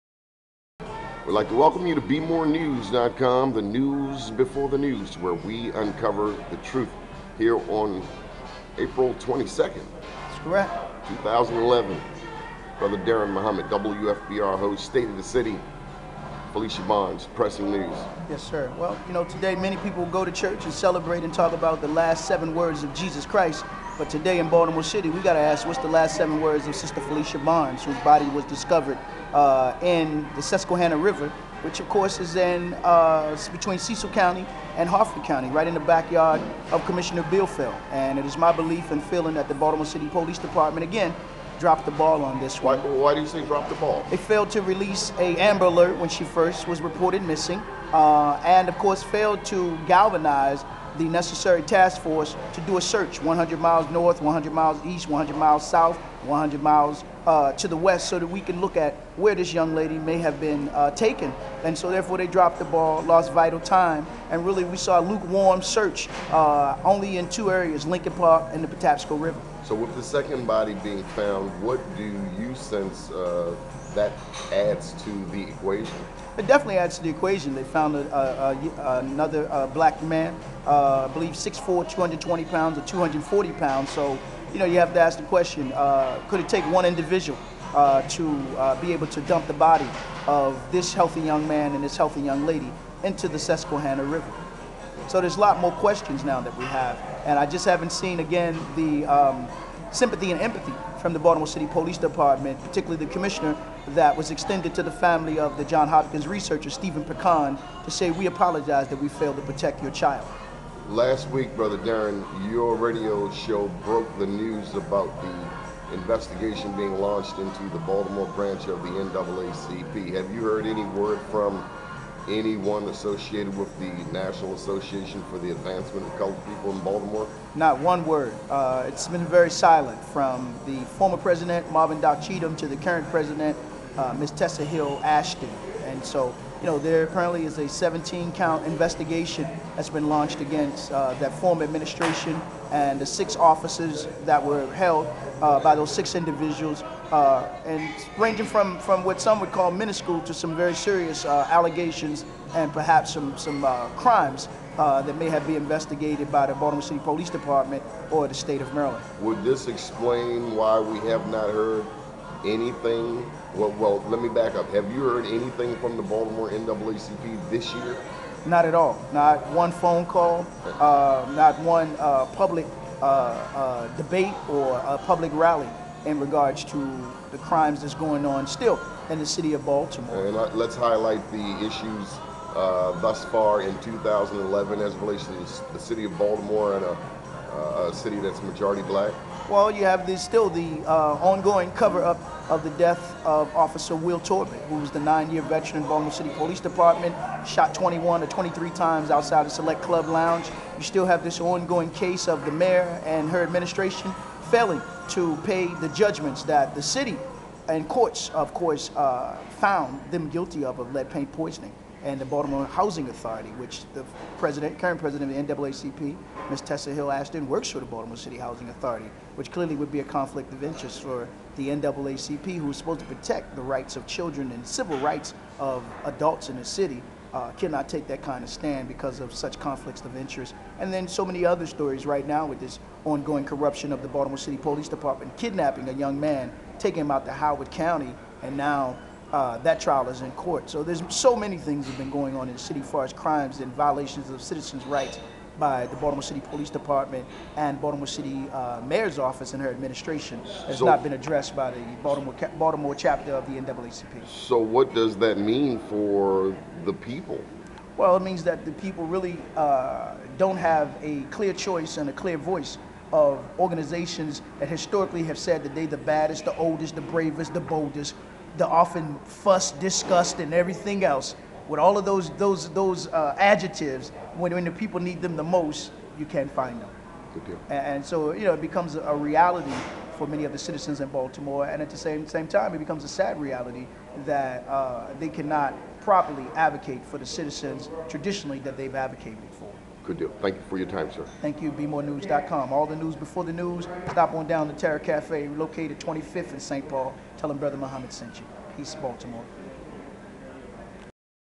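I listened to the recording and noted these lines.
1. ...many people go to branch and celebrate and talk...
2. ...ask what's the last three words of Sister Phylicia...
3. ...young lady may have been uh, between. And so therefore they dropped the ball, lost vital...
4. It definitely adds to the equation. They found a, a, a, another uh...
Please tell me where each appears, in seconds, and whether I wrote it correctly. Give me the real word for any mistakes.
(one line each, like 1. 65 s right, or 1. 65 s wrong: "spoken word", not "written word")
1. 19 s wrong: "church", not "branch"
2. 25 s wrong: "seven", not "three"
3. 59 s wrong: "taken", not "between"
4. 76 s right.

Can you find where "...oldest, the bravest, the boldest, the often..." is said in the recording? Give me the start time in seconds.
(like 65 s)
266 s.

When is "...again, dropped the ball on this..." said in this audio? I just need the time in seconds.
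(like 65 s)
40 s.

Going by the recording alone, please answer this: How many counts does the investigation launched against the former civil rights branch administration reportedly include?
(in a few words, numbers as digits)
17.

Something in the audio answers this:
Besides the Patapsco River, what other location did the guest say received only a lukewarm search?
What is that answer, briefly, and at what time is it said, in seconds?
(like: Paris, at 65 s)
Leakin Park, at 67 s.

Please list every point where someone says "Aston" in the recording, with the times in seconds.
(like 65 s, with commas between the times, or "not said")
134 s, 216 s.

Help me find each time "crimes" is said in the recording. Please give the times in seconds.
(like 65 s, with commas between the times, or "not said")
153 s, 177 s, 243 s.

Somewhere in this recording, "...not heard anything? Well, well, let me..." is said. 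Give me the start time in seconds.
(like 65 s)
161 s.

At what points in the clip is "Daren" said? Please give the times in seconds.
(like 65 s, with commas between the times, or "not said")
12 s, 111 s.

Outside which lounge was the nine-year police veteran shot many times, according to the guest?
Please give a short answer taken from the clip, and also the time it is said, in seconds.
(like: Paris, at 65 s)
Select Club Lounge, at 199 s.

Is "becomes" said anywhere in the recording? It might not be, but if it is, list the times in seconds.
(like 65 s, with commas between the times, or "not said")
278 s, 282 s.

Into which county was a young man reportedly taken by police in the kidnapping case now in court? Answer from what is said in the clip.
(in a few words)
Howard County.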